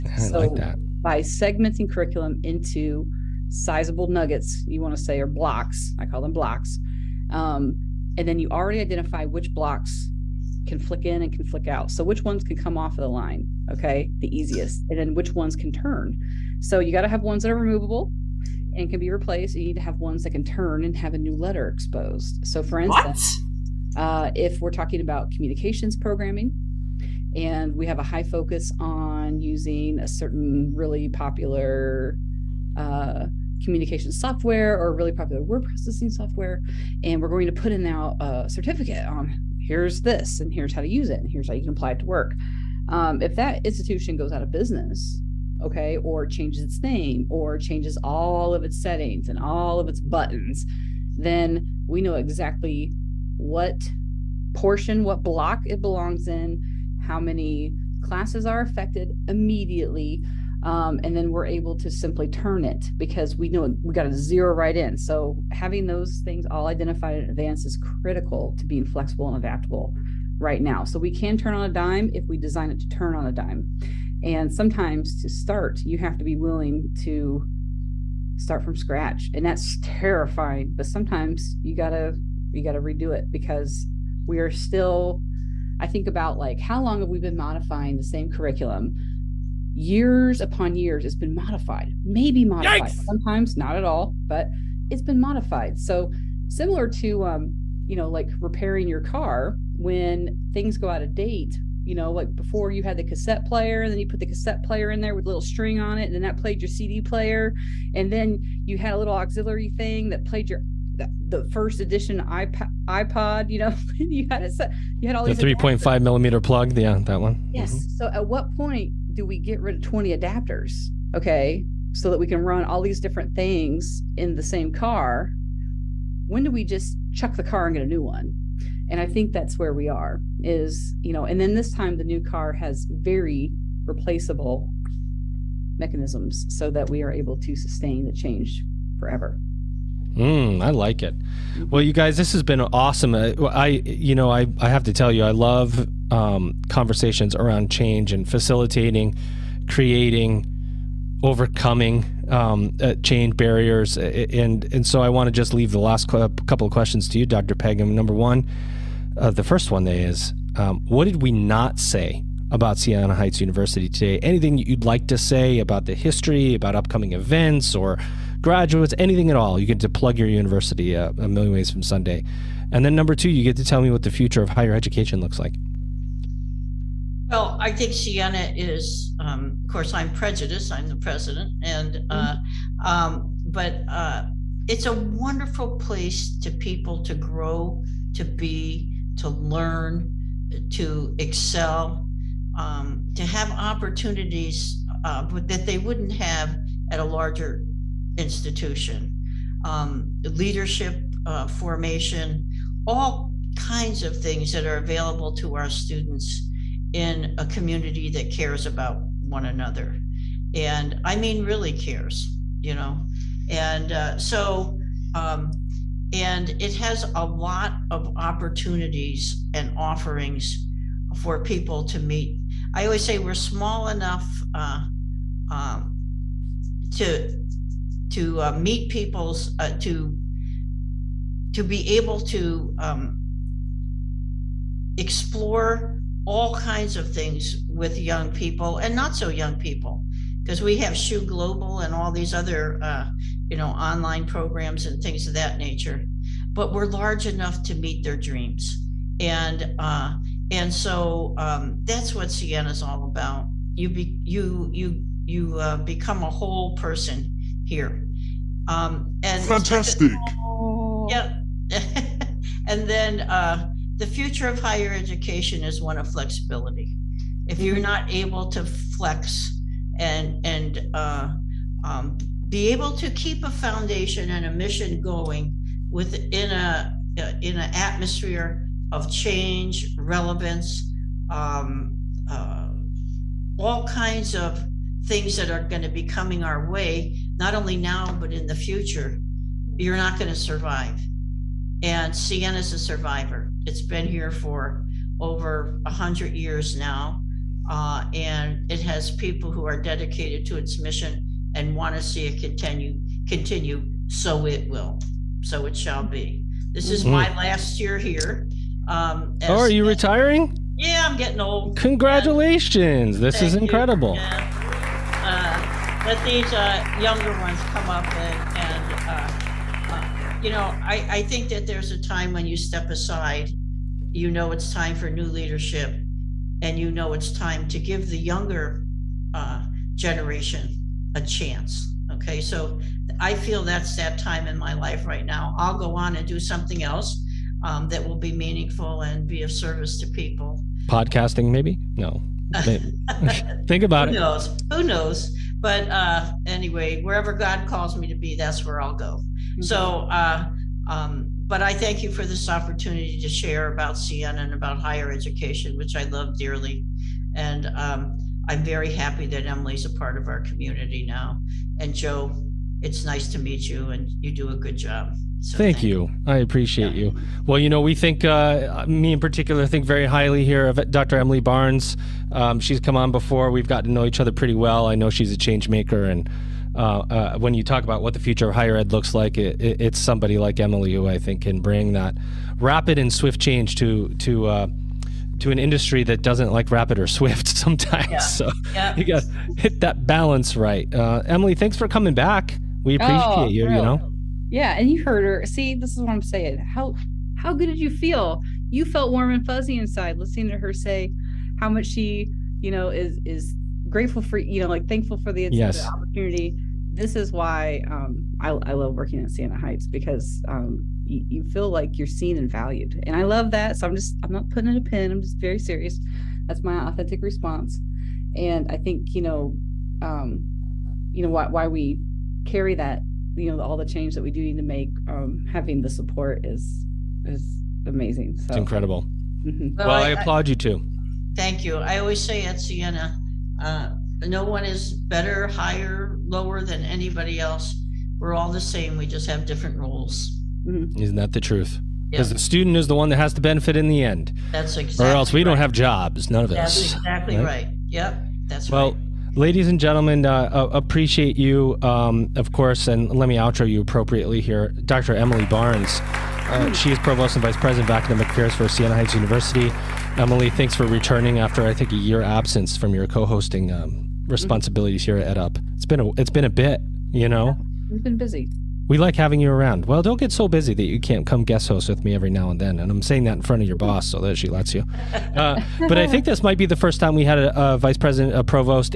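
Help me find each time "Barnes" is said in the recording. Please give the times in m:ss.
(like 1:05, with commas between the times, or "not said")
6:11, 7:35.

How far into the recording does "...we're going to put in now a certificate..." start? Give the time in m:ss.
0:37.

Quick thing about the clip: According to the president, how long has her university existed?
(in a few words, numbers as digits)
over 100 years.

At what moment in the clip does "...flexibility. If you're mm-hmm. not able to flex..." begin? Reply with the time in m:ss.
4:26.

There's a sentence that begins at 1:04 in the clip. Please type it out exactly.
So having those things all identified in advance is critical to being flexible and adaptable right now.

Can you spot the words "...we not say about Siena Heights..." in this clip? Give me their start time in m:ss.
2:41.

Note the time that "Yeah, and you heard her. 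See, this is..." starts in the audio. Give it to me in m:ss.
6:34.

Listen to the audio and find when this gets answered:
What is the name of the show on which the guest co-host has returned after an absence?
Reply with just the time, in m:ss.
7:45.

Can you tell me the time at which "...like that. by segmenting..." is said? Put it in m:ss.
0:00.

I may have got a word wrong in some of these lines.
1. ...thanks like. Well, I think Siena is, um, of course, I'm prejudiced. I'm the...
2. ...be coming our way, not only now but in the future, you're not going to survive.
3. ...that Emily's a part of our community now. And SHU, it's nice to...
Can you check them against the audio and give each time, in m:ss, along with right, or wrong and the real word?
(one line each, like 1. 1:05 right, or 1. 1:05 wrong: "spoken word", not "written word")
1. 2:55 wrong: "looks", not "thanks"
2. 4:45 right
3. 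5:59 wrong: "Joe", not "SHU".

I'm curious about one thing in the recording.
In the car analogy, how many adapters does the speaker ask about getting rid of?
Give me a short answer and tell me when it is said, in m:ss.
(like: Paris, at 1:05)
20, at 1:59.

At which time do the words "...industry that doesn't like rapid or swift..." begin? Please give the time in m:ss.
6:25.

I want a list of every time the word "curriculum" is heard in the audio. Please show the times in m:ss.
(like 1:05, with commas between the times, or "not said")
0:01, 1:28.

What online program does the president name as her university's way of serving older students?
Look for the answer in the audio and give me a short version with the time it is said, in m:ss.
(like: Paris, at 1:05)
SHU Global, at 4:00.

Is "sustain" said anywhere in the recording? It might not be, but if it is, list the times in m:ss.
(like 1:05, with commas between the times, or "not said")
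2:17.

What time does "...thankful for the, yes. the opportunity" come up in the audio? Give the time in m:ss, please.
6:44.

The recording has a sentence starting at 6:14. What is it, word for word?
I know she's a change maker.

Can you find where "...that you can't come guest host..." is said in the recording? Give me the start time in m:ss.
7:50.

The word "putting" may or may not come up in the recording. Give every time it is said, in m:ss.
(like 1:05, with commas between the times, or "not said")
6:54.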